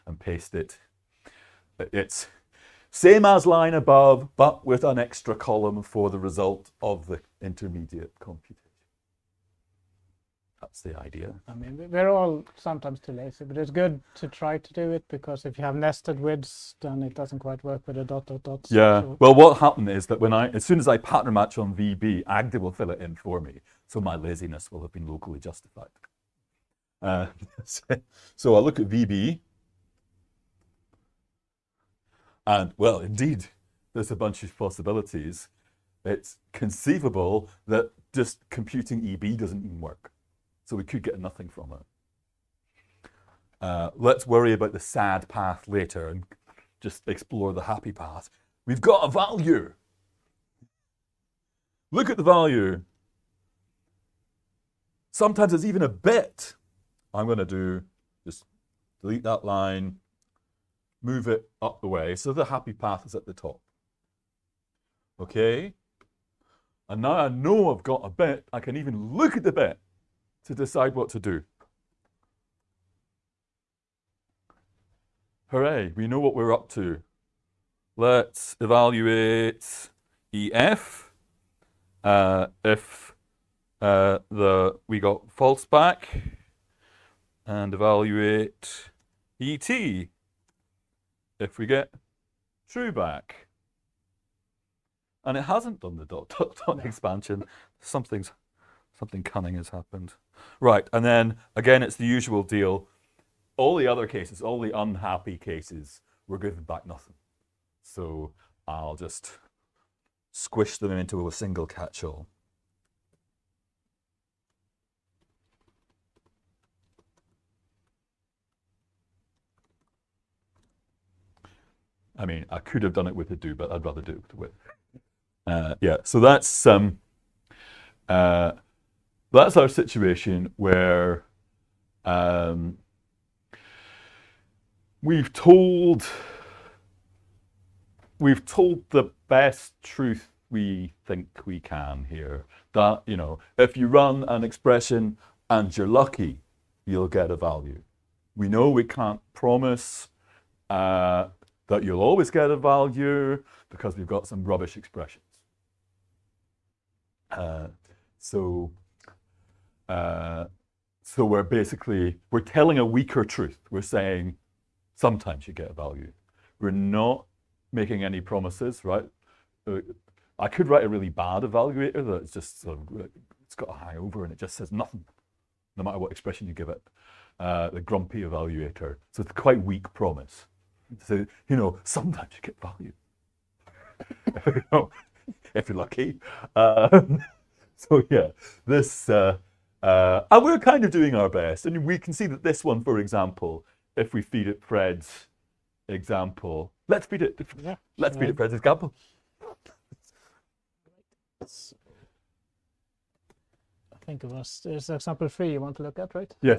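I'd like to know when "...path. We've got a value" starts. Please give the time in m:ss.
0:47.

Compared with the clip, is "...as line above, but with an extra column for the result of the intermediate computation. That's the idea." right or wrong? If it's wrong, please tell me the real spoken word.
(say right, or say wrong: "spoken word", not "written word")
right.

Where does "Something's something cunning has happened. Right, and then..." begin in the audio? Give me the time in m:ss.
1:37.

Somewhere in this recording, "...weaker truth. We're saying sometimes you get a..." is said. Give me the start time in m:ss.
2:42.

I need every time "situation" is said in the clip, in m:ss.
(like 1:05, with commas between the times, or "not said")
2:09.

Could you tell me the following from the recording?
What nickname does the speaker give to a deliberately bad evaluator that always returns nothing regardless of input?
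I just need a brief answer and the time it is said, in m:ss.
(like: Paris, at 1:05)
The grumpy evaluator, at 2:57.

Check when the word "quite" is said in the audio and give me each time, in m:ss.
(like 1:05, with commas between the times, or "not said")
0:17, 2:59.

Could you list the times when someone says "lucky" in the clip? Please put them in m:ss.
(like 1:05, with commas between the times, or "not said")
2:25, 3:05.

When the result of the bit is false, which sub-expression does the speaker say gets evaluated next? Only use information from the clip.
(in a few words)
EF.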